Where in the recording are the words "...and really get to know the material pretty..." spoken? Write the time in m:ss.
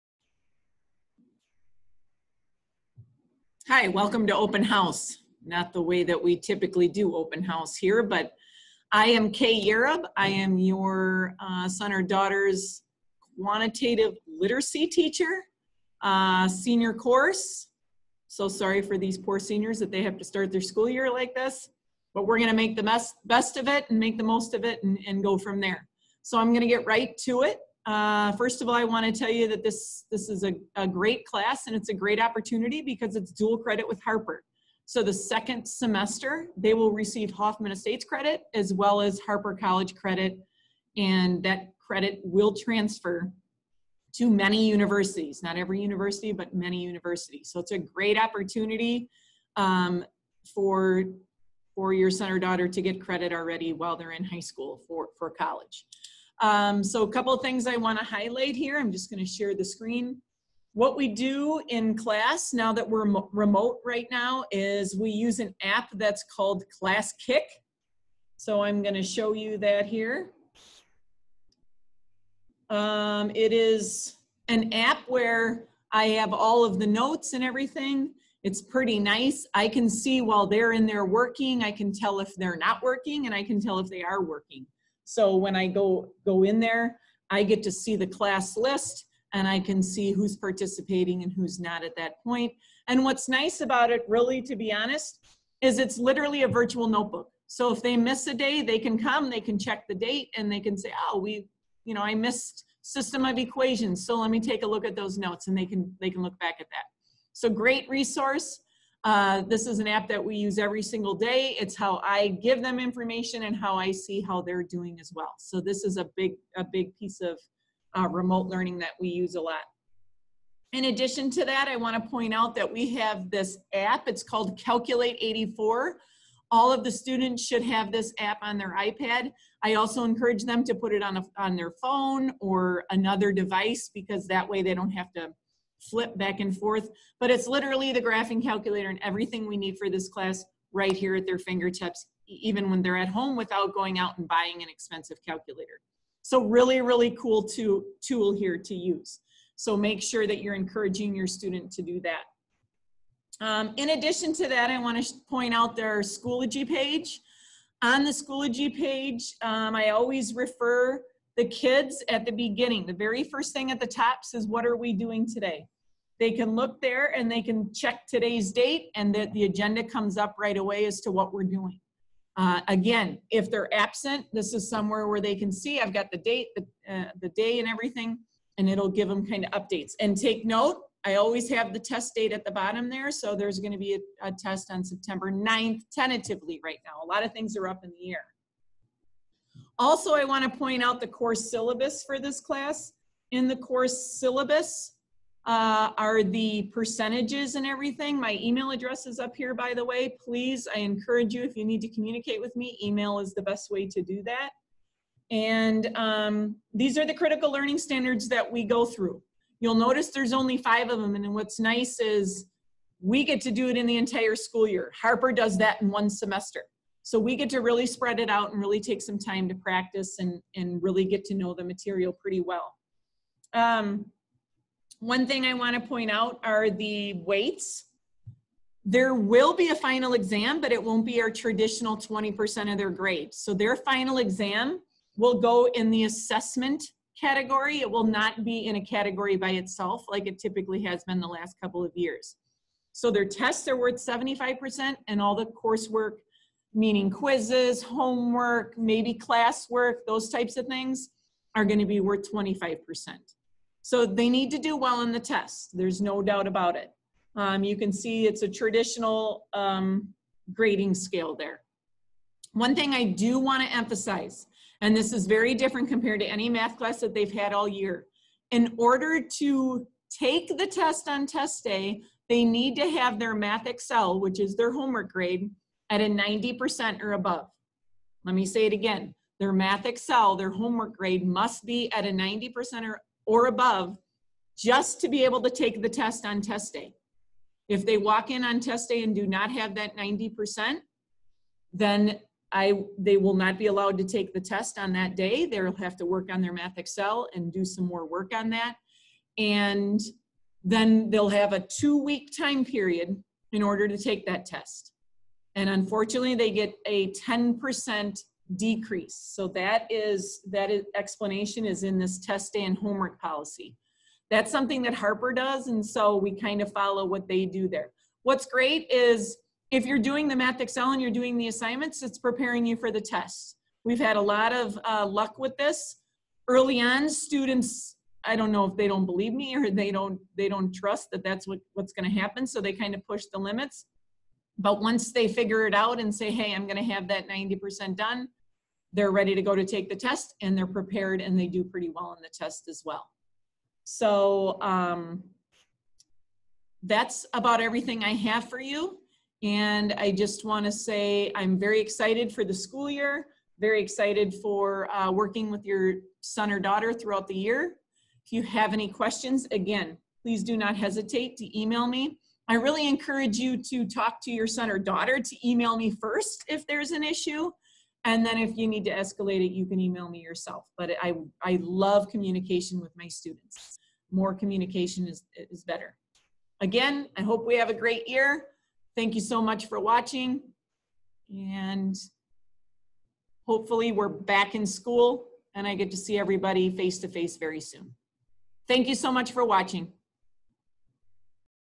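3:40.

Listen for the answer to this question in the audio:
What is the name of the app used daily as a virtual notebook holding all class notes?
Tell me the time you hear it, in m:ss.
1:06.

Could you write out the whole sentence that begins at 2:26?
So really, really cool to, tool here to use.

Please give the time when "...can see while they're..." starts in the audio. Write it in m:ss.
1:19.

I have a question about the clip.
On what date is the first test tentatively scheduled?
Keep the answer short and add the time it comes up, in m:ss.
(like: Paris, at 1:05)
September 9th, at 3:04.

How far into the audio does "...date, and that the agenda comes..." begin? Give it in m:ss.
2:48.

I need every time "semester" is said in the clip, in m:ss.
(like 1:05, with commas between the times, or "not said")
0:35, 3:36.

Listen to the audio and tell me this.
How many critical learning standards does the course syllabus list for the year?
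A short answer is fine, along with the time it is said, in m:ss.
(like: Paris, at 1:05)
5, at 3:30.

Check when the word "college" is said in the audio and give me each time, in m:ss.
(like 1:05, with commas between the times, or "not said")
0:39, 0:55.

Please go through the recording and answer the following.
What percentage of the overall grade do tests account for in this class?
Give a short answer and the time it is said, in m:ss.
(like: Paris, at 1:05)
75%, at 4:03.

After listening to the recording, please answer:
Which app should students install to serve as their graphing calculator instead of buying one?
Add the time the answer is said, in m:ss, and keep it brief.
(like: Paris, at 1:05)
Calculate 84, at 2:04.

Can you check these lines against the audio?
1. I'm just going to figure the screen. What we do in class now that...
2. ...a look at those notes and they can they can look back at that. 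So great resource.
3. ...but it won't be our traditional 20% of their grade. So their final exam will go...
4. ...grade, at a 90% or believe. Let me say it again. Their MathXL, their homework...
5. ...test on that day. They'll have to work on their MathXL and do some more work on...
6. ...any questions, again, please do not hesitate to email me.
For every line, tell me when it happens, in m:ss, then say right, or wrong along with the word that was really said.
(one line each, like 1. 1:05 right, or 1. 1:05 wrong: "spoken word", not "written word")
1. 0:58 wrong: "share", not "figure"
2. 1:44 right
3. 3:50 right
4. 4:35 wrong: "above", not "believe"
5. 4:54 right
6. 5:58 right.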